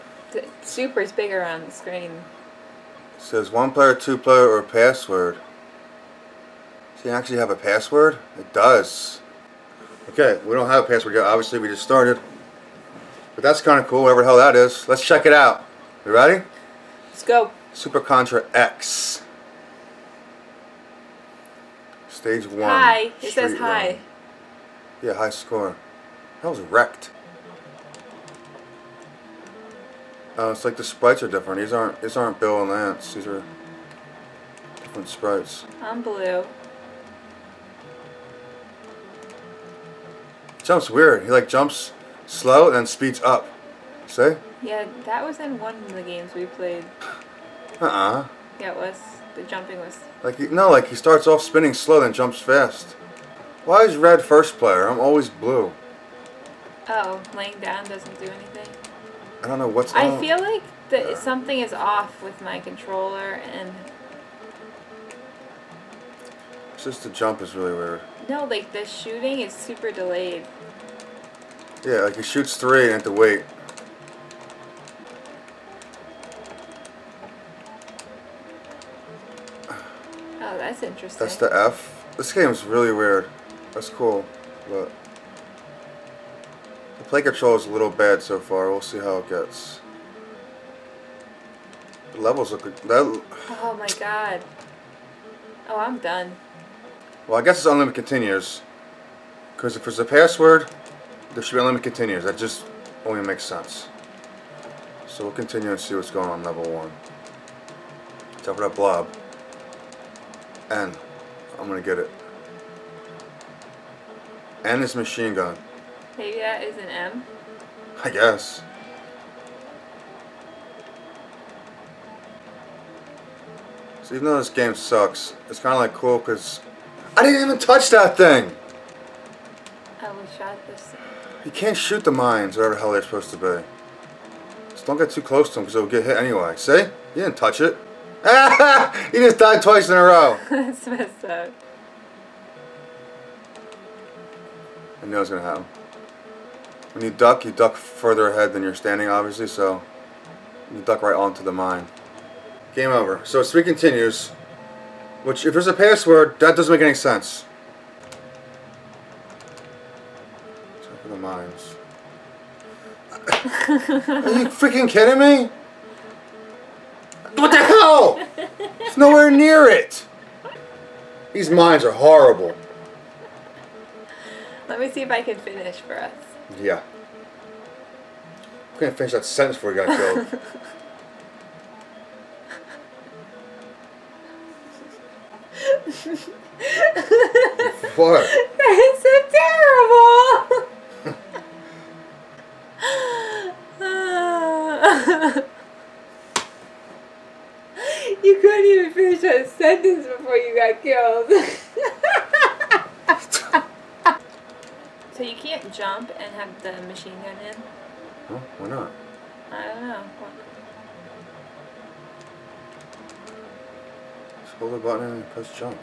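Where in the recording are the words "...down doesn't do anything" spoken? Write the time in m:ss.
0:57.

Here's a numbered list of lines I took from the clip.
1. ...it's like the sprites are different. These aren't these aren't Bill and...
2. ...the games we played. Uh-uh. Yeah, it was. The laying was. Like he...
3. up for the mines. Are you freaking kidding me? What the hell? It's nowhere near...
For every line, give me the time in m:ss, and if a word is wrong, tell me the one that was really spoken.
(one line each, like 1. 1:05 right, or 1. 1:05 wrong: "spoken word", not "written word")
1. 0:30 right
2. 0:45 wrong: "jumping", not "laying"
3. 2:40 right.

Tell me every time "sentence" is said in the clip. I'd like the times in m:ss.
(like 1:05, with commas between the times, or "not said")
2:59, 3:19.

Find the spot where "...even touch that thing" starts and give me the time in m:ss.
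2:07.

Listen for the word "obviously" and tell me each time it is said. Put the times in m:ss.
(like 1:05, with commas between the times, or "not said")
0:11, 2:29.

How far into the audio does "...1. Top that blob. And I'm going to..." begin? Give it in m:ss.
1:46.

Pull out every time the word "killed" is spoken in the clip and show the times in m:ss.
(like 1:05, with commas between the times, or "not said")
2:59, 3:20.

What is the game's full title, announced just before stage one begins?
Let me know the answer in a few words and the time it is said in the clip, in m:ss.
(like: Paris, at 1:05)
Super Contra X, at 0:17.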